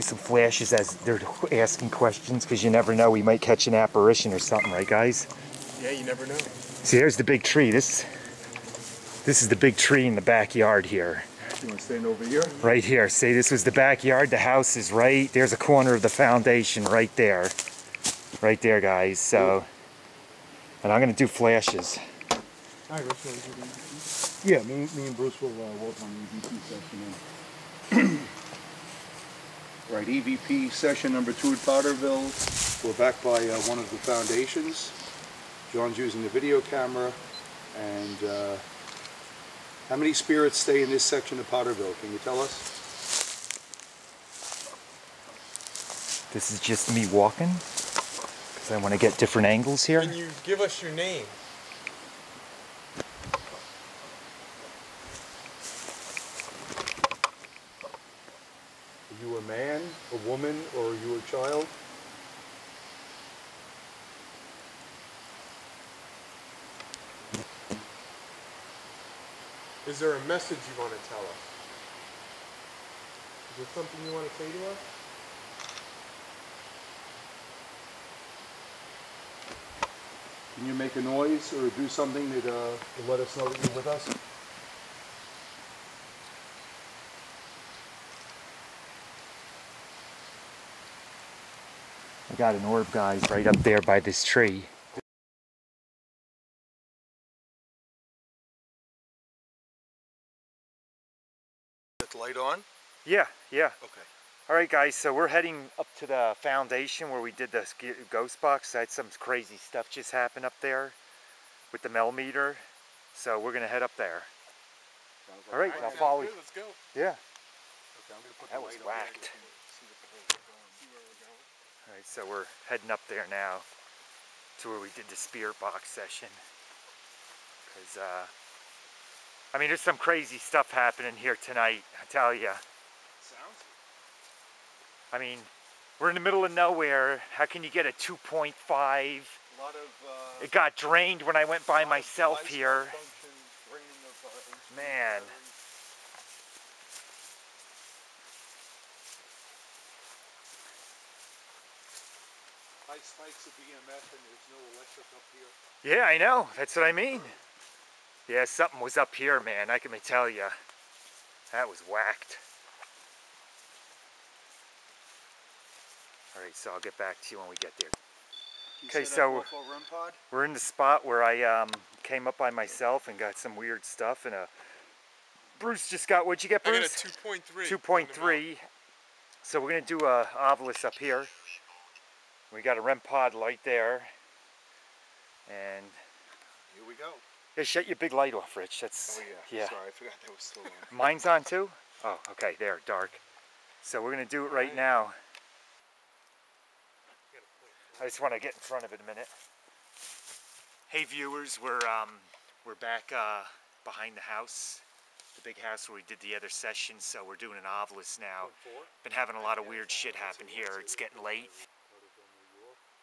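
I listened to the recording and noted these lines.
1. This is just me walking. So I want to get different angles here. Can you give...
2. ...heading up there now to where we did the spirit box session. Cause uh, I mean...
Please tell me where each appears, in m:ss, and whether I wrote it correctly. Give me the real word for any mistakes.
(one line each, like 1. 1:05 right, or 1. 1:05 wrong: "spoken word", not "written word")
1. 0:46 right
2. 2:02 right.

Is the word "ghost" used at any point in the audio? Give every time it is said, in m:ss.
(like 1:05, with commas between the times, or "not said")
1:48.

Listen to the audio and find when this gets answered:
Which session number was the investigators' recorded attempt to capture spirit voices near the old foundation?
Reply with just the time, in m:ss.
0:31.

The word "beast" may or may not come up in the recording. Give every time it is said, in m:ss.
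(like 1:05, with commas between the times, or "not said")
not said.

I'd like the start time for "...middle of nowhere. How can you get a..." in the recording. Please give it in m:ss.
2:16.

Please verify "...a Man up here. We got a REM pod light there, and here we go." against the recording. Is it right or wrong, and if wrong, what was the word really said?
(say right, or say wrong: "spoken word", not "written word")
wrong: "Ovilus", not "Man".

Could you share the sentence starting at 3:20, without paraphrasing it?
Hey viewers, we're um, we're back uh, behind the house, the big house where we did the other session.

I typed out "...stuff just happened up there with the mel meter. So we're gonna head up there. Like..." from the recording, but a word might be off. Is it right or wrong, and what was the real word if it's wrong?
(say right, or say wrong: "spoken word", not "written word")
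right.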